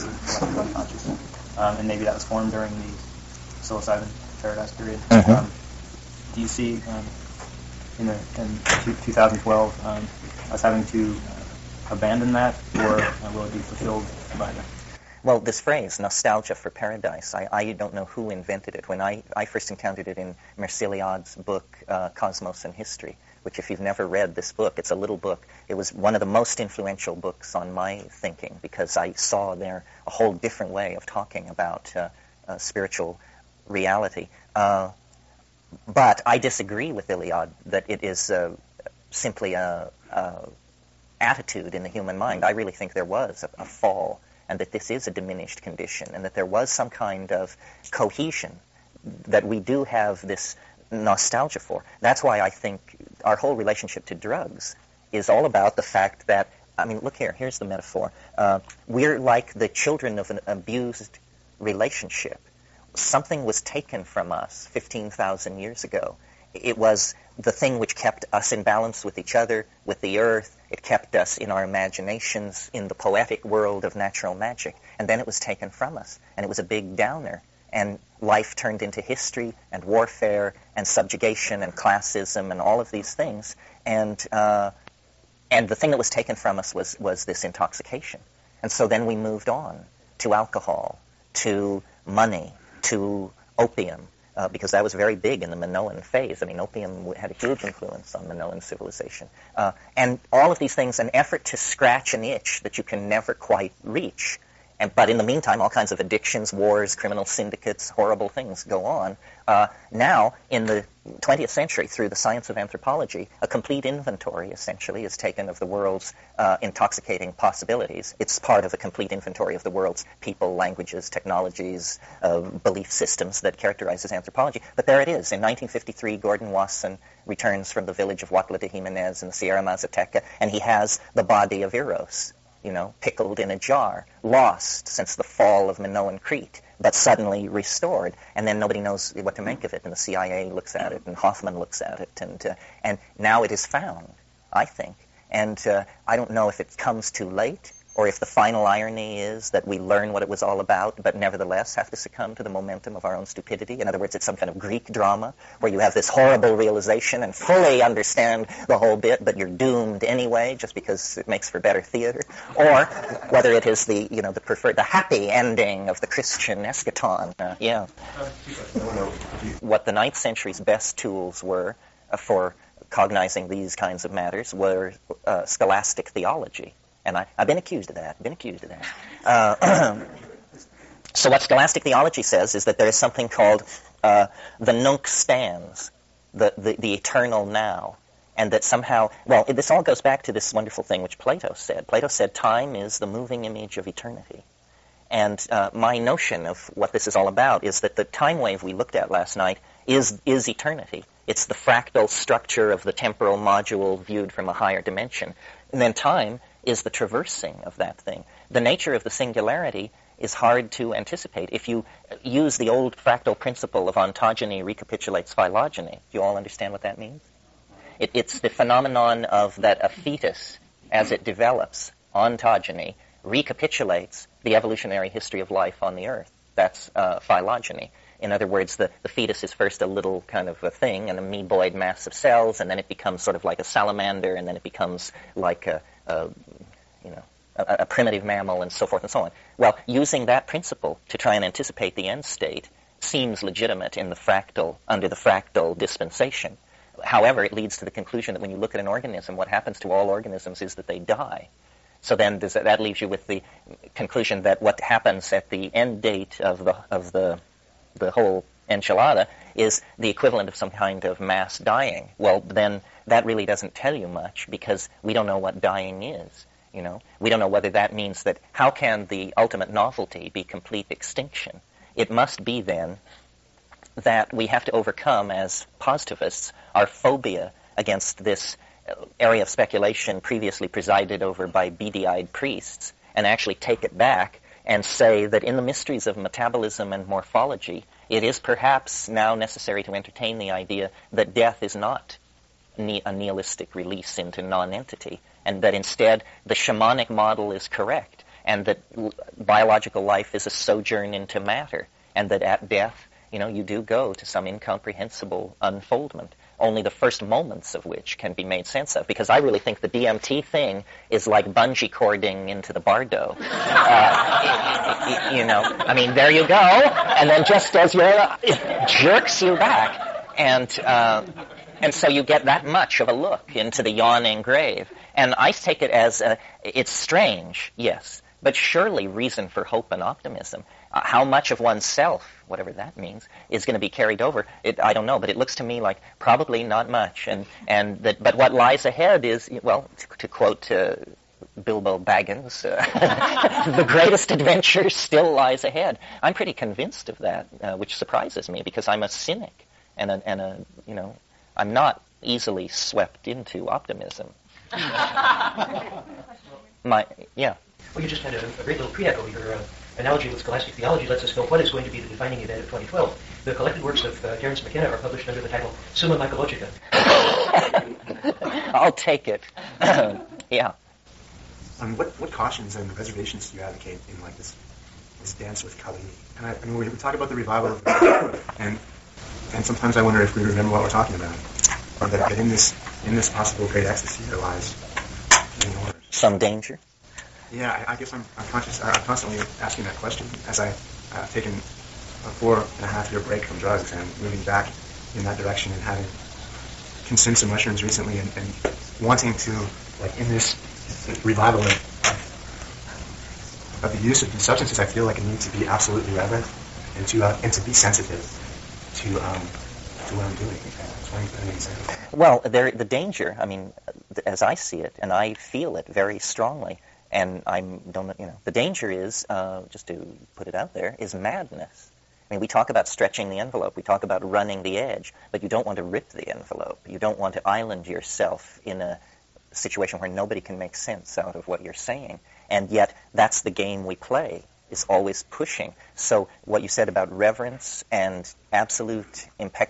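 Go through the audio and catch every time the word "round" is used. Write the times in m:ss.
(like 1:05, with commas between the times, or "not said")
not said.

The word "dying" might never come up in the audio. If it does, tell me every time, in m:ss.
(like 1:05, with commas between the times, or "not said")
4:21, 4:25.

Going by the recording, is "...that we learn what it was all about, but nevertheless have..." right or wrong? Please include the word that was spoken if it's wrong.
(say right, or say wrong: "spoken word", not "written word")
right.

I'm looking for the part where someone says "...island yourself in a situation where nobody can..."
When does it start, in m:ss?
7:07.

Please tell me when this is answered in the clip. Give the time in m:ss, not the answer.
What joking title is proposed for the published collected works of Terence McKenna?
6:05.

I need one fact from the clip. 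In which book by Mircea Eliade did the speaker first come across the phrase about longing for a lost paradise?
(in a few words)
Cosmos and History.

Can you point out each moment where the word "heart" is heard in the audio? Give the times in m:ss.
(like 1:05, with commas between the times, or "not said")
not said.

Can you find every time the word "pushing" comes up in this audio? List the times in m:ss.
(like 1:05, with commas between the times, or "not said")
7:15.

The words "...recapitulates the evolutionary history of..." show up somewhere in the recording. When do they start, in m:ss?
3:43.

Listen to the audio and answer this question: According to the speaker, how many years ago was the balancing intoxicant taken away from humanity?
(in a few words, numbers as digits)
15,000.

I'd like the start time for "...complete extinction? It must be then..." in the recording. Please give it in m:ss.
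4:30.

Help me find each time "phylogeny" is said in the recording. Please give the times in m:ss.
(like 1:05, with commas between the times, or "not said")
3:35, 3:47.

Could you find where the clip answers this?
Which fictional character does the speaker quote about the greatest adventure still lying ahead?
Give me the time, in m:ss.
5:41.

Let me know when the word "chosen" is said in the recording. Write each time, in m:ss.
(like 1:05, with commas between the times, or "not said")
not said.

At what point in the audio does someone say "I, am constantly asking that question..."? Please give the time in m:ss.
6:28.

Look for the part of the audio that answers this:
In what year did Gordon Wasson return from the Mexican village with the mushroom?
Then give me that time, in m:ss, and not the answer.
2:05.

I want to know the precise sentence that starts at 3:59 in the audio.
Well, using that principle to try and anticipate the end state seems legitimate in the fractal, under the fractal dispensation.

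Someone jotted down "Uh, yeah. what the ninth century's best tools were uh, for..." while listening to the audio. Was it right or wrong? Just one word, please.
right.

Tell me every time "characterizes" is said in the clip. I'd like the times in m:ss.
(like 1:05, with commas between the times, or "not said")
2:03.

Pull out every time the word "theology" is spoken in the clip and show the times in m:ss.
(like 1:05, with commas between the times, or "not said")
2:56, 3:01, 6:00.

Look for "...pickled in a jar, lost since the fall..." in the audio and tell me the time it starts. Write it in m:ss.
2:12.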